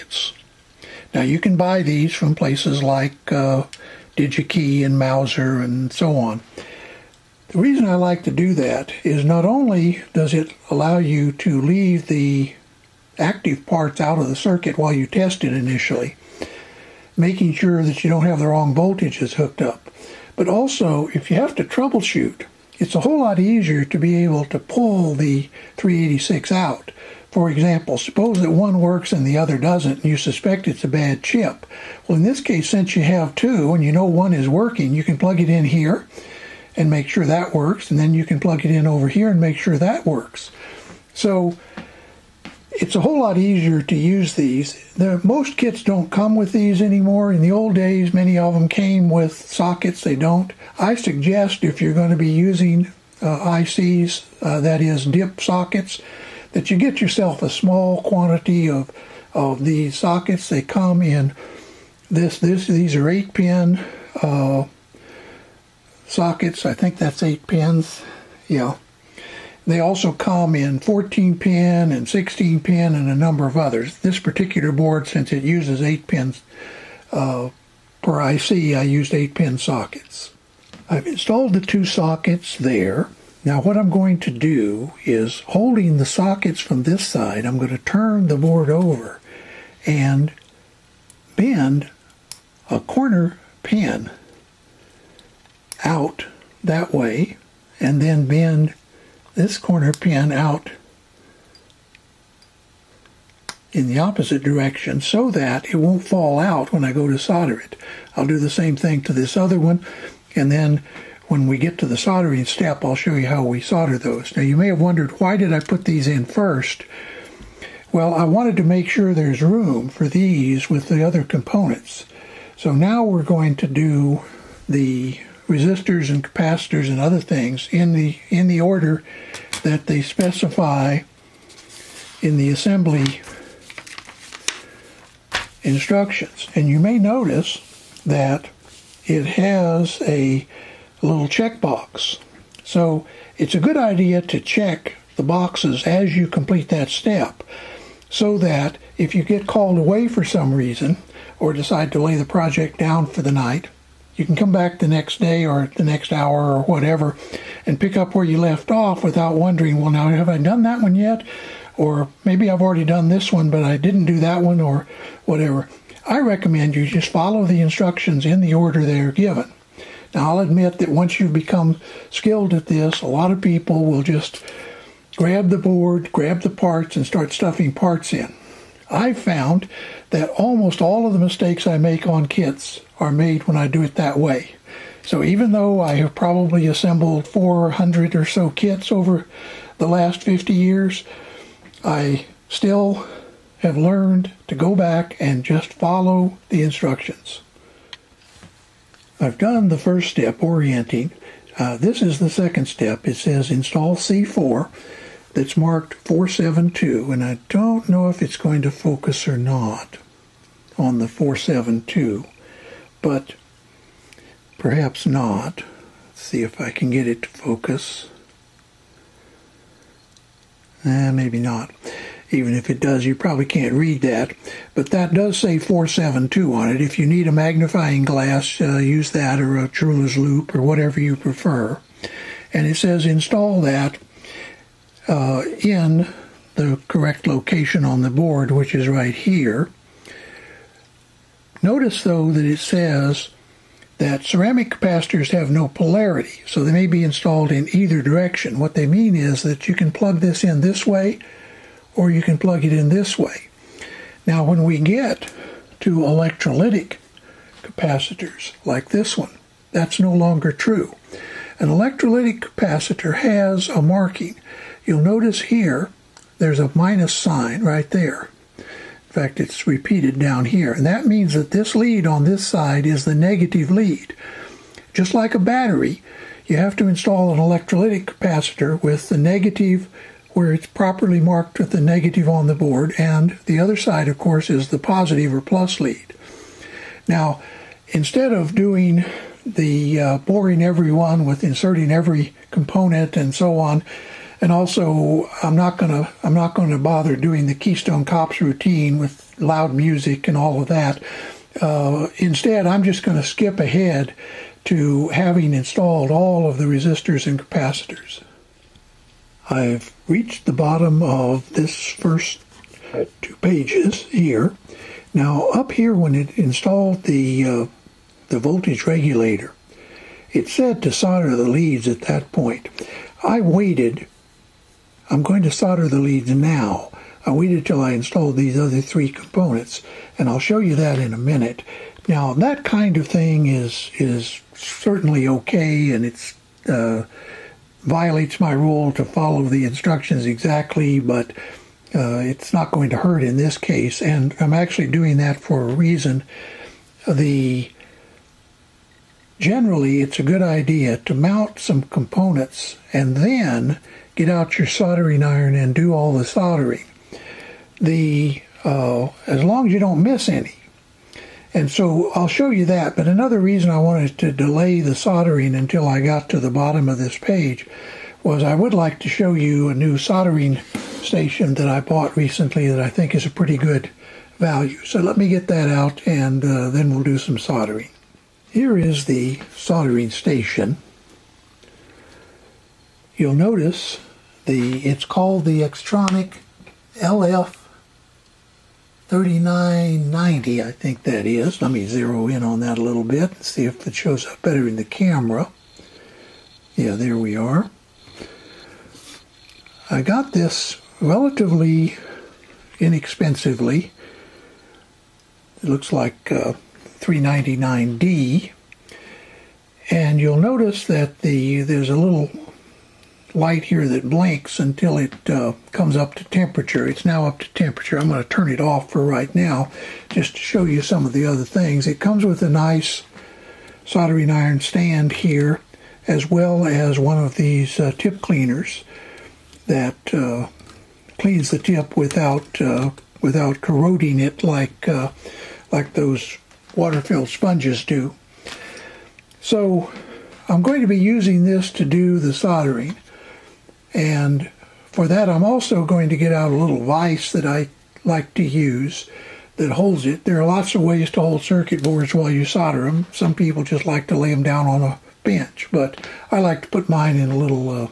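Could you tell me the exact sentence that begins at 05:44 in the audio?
And I'm actually doing that for a reason.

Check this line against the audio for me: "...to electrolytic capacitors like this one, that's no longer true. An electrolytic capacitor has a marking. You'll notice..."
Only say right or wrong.
right.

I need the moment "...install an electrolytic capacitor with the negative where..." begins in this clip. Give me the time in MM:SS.
04:36.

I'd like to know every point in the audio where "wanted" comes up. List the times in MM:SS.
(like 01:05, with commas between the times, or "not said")
01:58, 06:03.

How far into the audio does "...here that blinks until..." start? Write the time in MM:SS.
06:53.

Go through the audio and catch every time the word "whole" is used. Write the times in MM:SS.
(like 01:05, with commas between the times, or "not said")
00:22, 00:42.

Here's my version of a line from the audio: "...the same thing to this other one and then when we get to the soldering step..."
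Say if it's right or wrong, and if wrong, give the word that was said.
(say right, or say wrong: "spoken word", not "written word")
right.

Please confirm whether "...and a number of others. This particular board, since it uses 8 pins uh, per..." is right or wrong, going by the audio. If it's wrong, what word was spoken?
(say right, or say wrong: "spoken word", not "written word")
right.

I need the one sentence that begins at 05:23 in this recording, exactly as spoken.
I waited I'm going to solder the leads now.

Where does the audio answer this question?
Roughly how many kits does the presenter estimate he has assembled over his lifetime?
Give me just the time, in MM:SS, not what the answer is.
03:07.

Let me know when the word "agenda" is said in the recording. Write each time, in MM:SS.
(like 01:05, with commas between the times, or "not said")
not said.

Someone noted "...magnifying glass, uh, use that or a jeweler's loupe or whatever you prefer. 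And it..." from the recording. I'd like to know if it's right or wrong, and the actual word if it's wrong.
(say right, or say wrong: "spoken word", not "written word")
right.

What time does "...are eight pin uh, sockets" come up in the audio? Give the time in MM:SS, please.
01:02.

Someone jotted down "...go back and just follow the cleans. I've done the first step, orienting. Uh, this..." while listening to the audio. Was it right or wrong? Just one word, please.
wrong.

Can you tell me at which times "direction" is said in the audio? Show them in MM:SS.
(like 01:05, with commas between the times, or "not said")
01:44, 04:08.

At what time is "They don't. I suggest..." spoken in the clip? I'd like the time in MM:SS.
00:50.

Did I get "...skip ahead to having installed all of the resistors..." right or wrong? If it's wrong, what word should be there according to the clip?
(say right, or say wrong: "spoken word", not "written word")
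right.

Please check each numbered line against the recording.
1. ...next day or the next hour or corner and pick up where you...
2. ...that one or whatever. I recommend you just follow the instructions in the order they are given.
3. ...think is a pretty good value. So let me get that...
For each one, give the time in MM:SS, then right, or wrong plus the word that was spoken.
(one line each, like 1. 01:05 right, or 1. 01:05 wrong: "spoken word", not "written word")
1. 02:34 wrong: "whatever", not "corner"
2. 02:44 right
3. 06:12 right.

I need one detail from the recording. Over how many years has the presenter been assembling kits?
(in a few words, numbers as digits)
50.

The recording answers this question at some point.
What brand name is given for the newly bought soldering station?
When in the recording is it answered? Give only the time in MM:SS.
06:25.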